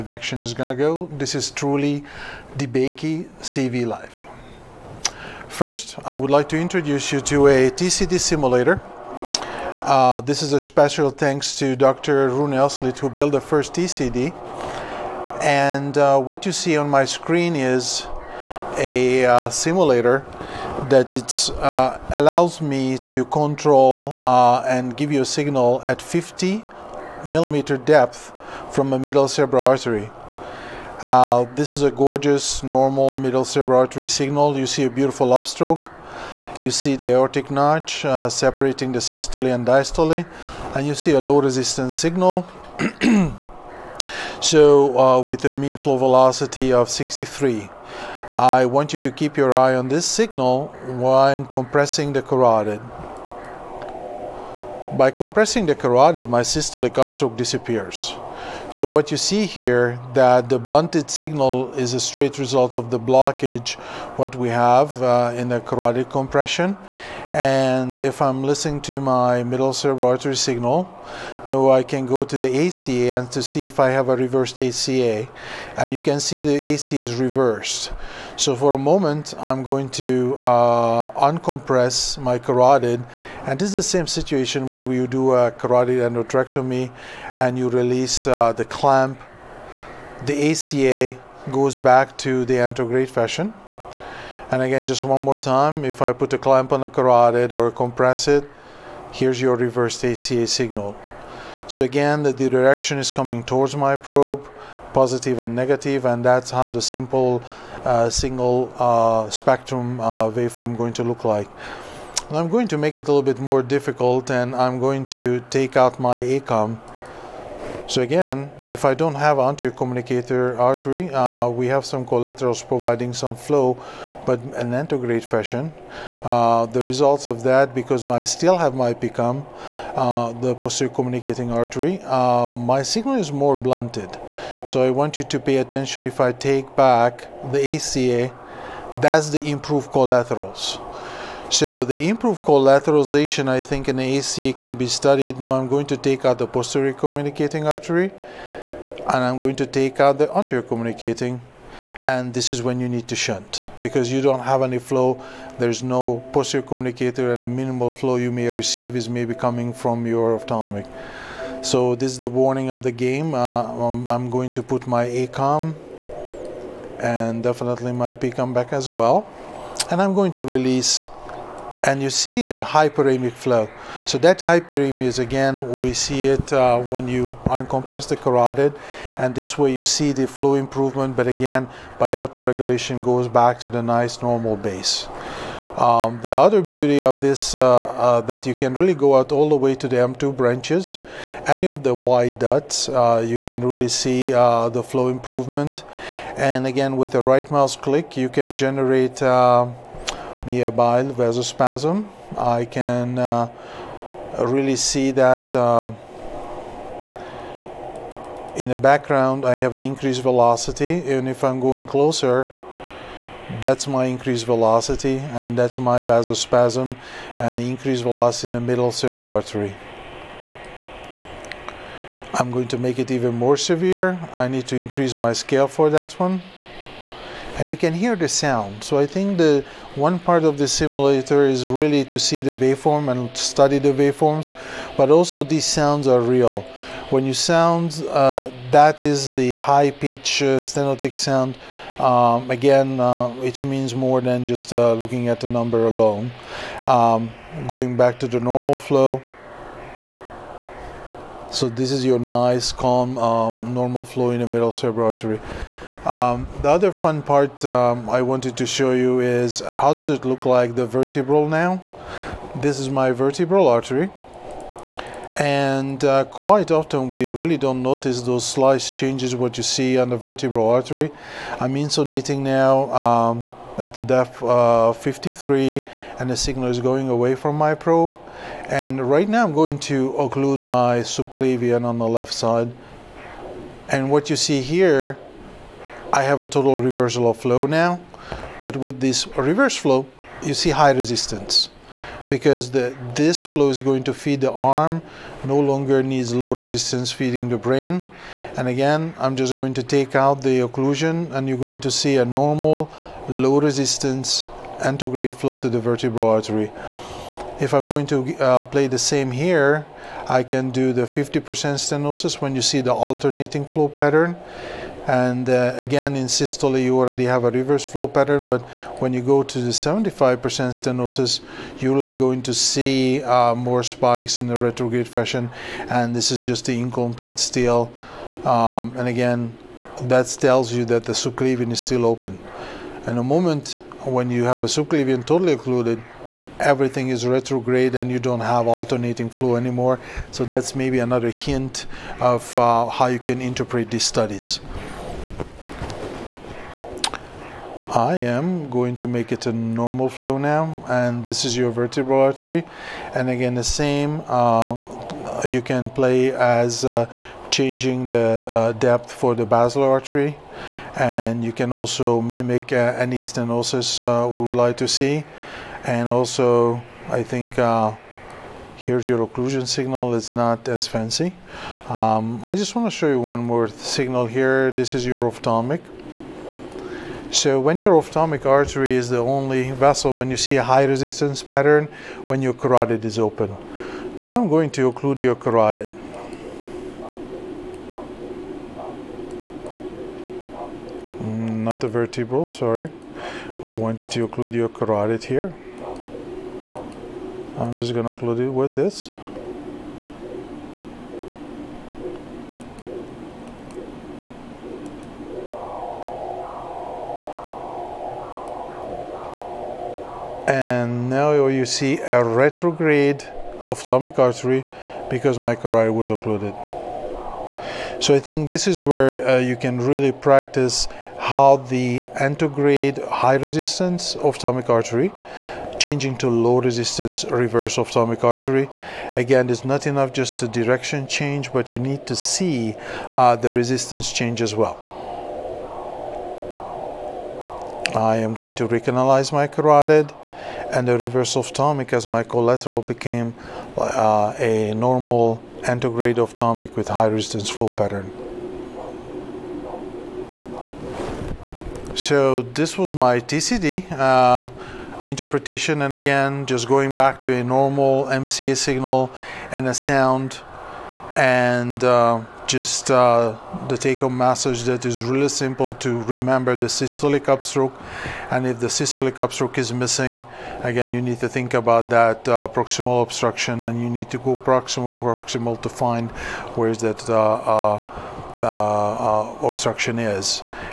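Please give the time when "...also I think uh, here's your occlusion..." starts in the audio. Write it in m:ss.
6:06.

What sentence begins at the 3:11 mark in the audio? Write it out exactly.
Any of the wide dots, uh, you can really see uh, the flow improvement.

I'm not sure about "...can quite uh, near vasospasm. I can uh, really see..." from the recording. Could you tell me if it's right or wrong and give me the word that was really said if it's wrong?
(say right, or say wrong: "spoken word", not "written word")
wrong: "generate", not "quite".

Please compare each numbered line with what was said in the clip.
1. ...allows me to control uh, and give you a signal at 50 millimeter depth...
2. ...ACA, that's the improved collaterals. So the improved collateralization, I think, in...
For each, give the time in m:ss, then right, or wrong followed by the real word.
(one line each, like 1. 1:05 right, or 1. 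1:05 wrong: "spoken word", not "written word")
1. 0:22 right
2. 2:17 right.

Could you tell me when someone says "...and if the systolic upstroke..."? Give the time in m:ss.
7:48.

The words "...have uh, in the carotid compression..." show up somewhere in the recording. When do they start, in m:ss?
1:04.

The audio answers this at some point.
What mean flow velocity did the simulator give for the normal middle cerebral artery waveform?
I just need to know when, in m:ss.
0:46.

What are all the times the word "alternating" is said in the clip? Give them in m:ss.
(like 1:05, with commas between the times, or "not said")
5:12, 5:38.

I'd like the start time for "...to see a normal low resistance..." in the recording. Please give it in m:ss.
5:01.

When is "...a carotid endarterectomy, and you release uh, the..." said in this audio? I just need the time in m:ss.
1:25.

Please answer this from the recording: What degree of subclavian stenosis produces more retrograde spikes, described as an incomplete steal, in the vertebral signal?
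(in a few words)
75%.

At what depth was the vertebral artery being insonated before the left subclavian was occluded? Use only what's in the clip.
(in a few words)
53.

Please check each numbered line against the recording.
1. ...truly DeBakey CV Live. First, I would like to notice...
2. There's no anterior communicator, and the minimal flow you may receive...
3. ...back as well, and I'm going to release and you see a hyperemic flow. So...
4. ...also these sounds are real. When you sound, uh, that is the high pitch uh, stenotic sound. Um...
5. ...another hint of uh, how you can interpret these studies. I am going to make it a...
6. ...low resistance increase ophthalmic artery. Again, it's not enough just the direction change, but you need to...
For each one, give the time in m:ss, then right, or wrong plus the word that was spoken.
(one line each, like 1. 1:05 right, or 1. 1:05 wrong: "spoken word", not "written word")
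1. 0:01 wrong: "introduce", not "notice"
2. 2:35 wrong: "posterior", not "anterior"
3. 2:48 right
4. 3:55 right
5. 5:40 right
6. 7:06 wrong: "reverse", not "increase".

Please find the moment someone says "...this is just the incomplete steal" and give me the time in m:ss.
5:26.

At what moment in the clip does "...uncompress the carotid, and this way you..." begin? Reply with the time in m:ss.
2:57.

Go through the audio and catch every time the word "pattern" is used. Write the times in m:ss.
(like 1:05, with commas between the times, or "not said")
5:13, 5:18, 6:21, 7:27.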